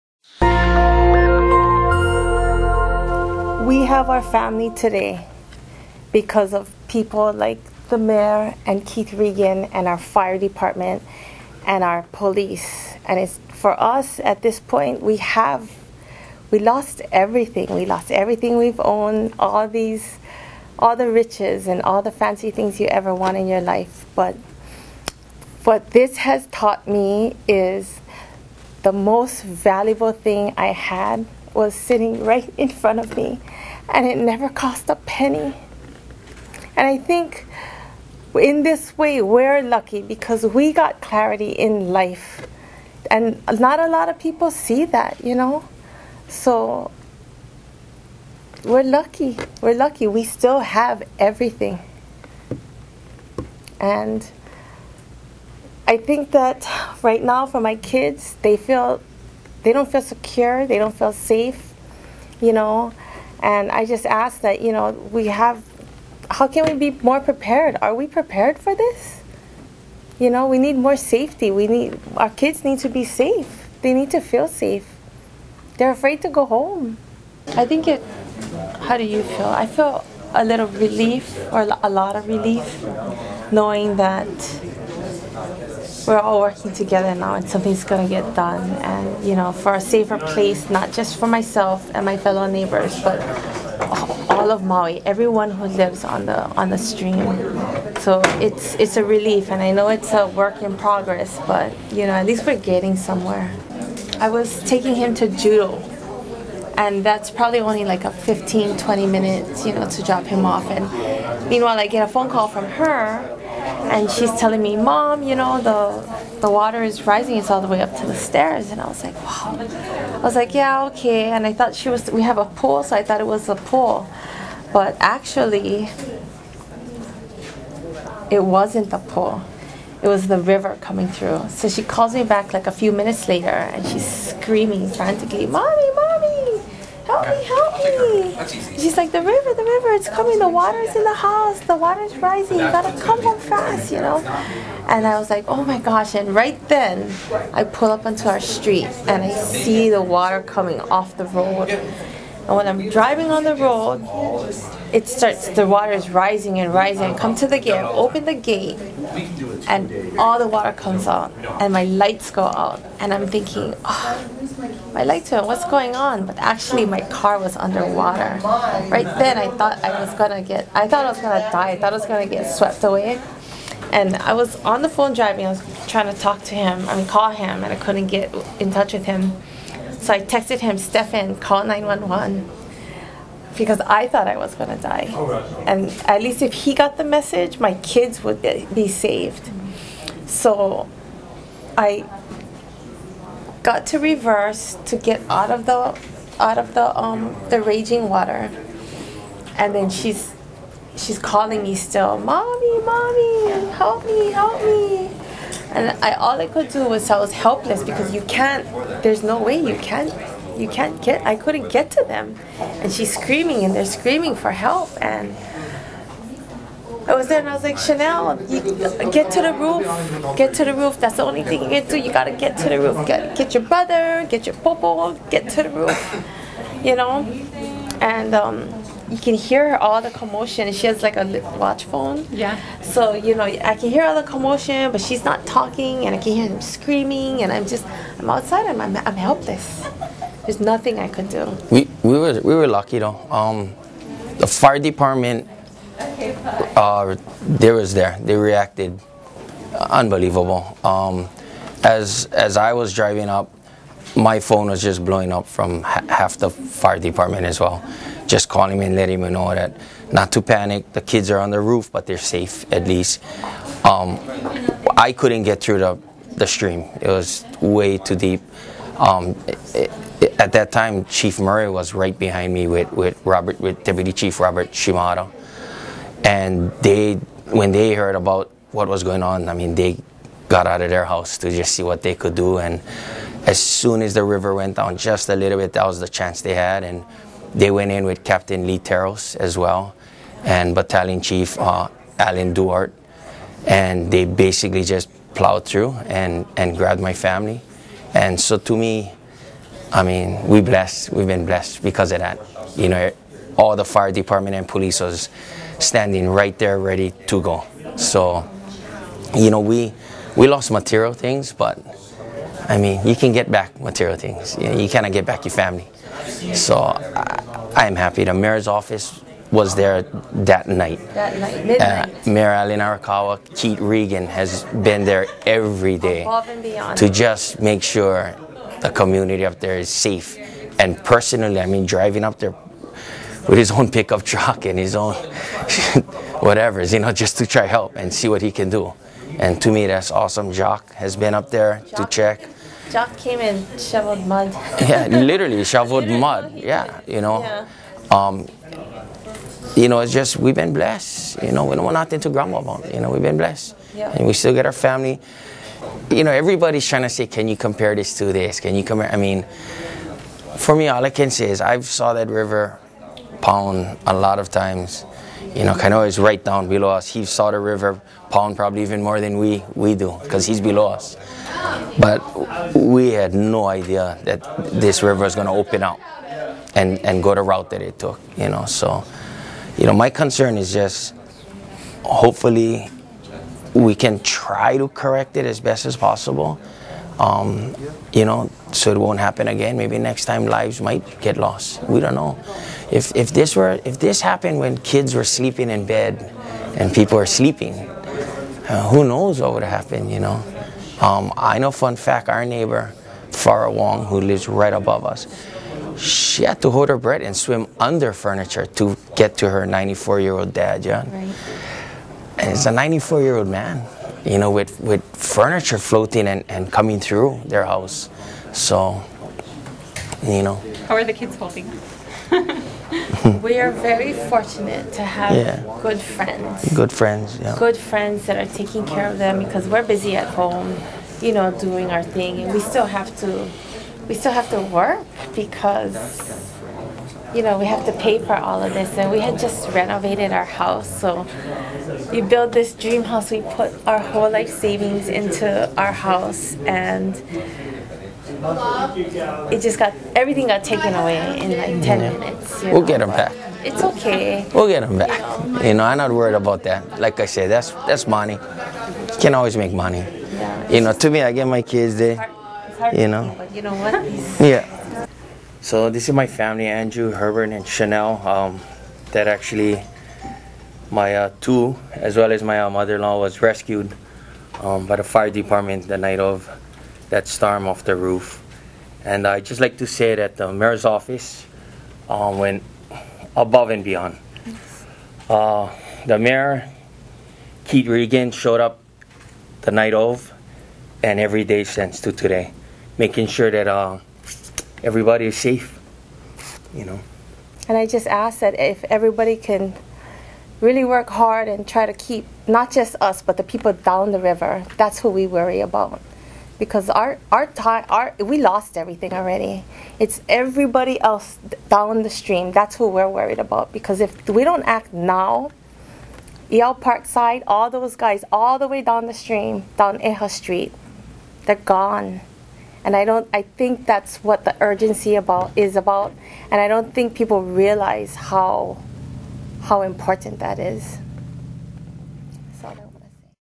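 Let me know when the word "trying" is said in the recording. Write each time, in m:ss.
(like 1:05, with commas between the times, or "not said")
2:55, 5:56.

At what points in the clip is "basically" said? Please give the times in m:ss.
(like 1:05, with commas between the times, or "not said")
4:54.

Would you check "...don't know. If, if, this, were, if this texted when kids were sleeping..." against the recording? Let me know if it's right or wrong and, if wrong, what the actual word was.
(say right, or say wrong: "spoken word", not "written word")
wrong: "happened", not "texted".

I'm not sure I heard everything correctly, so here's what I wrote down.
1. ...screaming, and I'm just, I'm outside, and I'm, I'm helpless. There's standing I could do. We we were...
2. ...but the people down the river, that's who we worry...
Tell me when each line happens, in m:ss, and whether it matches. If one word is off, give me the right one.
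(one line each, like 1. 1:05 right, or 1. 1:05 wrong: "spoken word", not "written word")
1. 3:56 wrong: "nothing", not "standing"
2. 8:23 right.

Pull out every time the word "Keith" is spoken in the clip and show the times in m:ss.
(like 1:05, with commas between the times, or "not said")
0:08, 5:23, 8:07.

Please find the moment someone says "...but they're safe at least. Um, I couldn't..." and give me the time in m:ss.
4:21.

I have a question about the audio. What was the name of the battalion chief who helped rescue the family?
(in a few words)
Alan Duart.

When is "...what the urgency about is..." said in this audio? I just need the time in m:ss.
8:44.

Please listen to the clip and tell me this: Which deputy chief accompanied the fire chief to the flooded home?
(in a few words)
Robert Shimada.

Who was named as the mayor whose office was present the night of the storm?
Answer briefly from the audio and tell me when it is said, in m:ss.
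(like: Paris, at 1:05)
Alan Arakawa, at 5:22.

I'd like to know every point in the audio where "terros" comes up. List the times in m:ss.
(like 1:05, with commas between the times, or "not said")
4:48.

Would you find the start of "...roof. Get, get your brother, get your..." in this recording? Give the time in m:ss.
3:42.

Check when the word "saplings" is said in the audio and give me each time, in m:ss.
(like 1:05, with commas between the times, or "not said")
not said.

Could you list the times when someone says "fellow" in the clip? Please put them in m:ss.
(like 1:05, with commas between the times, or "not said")
1:32.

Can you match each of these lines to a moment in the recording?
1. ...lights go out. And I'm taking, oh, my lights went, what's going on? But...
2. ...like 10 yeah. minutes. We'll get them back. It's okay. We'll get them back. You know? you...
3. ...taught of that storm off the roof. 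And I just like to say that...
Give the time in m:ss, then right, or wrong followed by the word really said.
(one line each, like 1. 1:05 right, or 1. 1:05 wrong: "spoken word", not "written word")
1. 2:41 wrong: "thinking", not "taking"
2. 7:31 right
3. 7:55 wrong: "night", not "taught".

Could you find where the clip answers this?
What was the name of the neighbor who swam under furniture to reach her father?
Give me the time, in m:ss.
6:43.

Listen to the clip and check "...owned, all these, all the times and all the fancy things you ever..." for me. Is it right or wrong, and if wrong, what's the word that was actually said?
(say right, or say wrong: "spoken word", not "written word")
wrong: "riches", not "times".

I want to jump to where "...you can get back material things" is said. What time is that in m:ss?
5:13.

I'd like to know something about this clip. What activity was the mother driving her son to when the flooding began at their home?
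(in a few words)
Judo.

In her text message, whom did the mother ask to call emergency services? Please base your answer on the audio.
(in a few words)
Stefan.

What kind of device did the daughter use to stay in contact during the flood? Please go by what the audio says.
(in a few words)
A watch phone.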